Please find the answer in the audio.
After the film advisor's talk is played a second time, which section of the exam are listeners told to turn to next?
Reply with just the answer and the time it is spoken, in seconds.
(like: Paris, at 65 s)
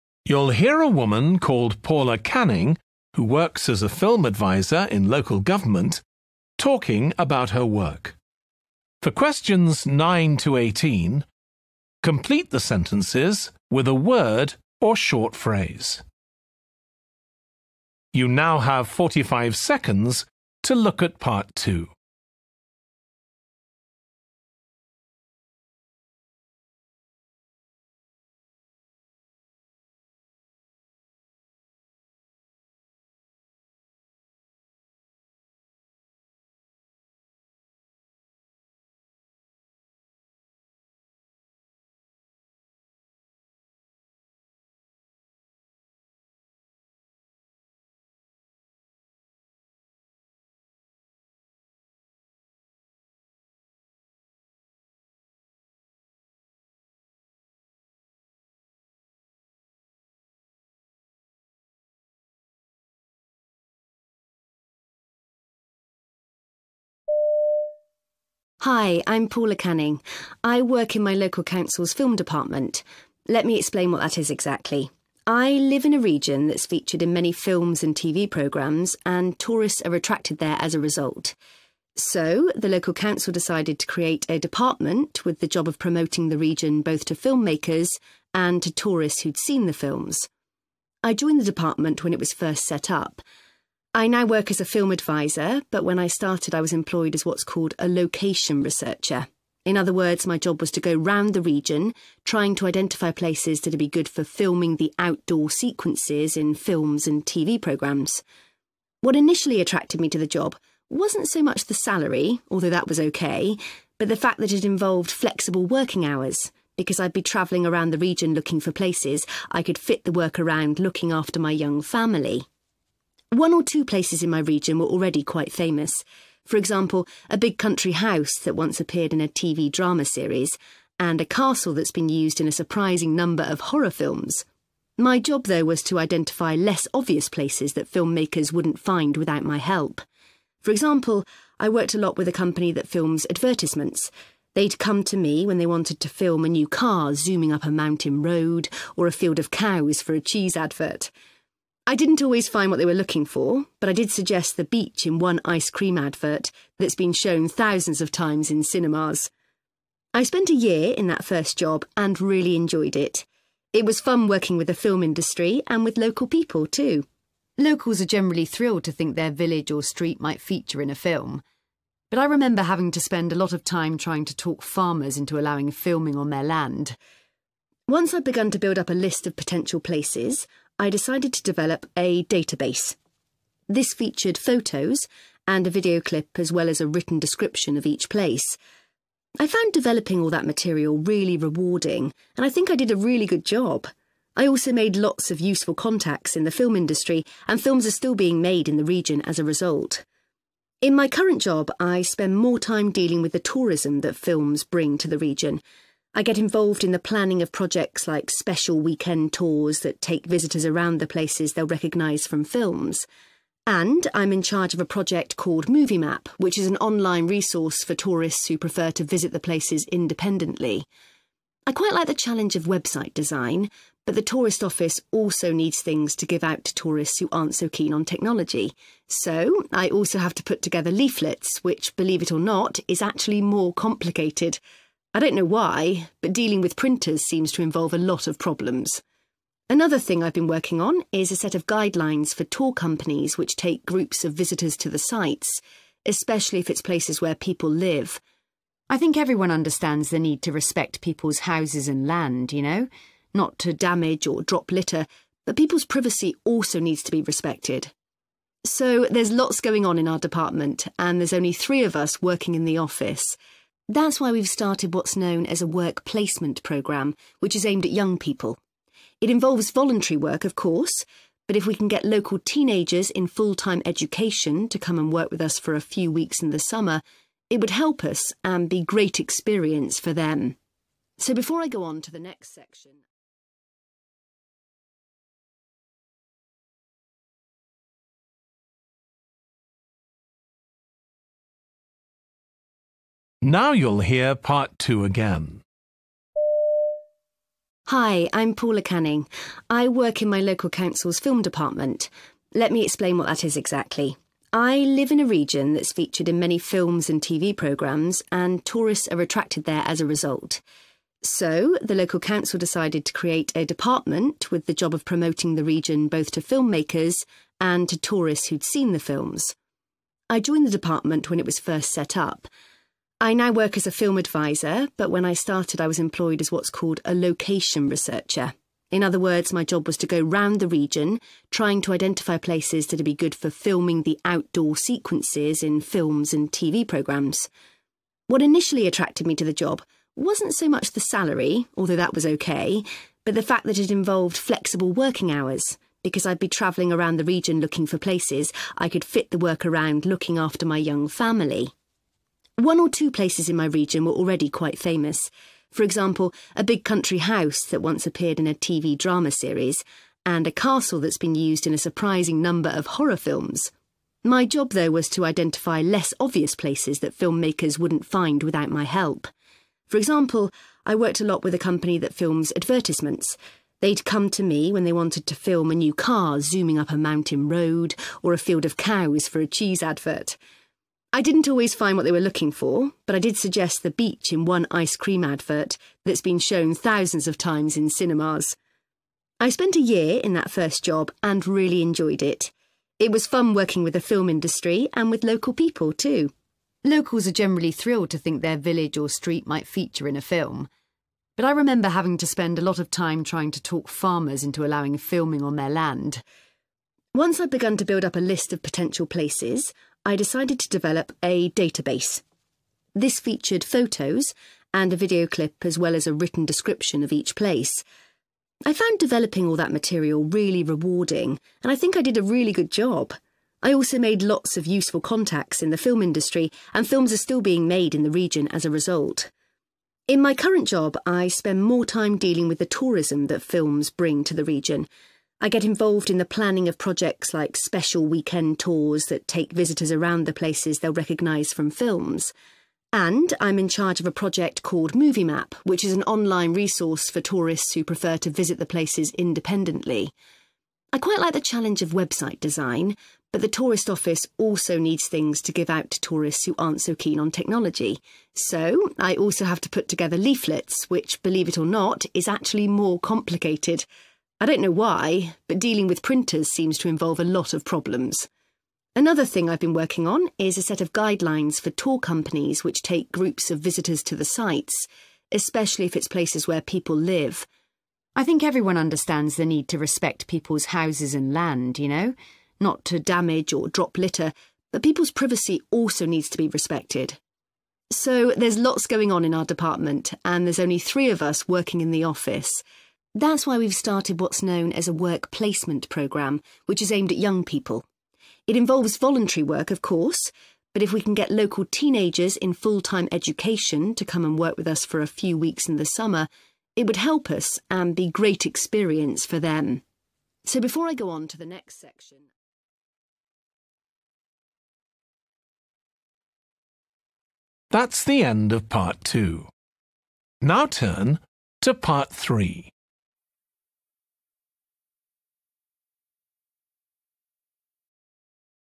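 part three, at 521 s.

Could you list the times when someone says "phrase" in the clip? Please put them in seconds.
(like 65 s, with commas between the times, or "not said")
15 s.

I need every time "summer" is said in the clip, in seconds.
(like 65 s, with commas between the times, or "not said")
276 s, 505 s.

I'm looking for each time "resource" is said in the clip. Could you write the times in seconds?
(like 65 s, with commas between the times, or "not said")
217 s, 446 s.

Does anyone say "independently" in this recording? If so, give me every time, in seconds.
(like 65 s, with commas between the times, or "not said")
219 s, 449 s.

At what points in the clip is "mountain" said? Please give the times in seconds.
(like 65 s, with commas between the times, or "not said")
147 s, 376 s.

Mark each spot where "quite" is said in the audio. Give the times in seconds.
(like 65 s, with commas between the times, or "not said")
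125 s, 221 s, 354 s, 450 s.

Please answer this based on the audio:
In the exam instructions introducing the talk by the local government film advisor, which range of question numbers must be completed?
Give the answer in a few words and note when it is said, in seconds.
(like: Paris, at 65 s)
9 to 18, at 9 s.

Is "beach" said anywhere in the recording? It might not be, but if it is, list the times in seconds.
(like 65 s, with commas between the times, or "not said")
154 s, 383 s.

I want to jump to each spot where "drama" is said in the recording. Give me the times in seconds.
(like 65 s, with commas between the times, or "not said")
129 s, 358 s.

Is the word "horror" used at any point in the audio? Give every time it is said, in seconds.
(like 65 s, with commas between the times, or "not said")
133 s, 362 s.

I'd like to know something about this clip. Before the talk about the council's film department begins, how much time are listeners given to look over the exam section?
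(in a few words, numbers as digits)
45 seconds.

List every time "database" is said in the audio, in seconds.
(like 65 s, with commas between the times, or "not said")
182 s, 411 s.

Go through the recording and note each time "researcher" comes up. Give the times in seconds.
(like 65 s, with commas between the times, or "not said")
98 s, 327 s.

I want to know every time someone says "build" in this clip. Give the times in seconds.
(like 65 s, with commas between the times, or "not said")
178 s, 407 s.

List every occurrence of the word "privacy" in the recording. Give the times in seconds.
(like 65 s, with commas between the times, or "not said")
255 s, 485 s.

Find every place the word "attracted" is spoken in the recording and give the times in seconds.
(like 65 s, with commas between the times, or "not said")
79 s, 109 s, 309 s, 338 s.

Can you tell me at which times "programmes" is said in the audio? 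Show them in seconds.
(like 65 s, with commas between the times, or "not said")
78 s, 107 s, 266 s, 307 s, 336 s, 495 s.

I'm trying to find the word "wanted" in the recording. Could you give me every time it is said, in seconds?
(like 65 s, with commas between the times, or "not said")
145 s, 374 s.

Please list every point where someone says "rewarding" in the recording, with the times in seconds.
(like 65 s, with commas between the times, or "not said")
191 s, 420 s.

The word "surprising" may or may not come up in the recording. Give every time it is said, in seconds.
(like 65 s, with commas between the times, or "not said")
132 s, 361 s.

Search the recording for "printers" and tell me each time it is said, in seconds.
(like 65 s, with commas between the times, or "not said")
236 s, 466 s.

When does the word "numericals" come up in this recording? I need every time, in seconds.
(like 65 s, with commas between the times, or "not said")
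not said.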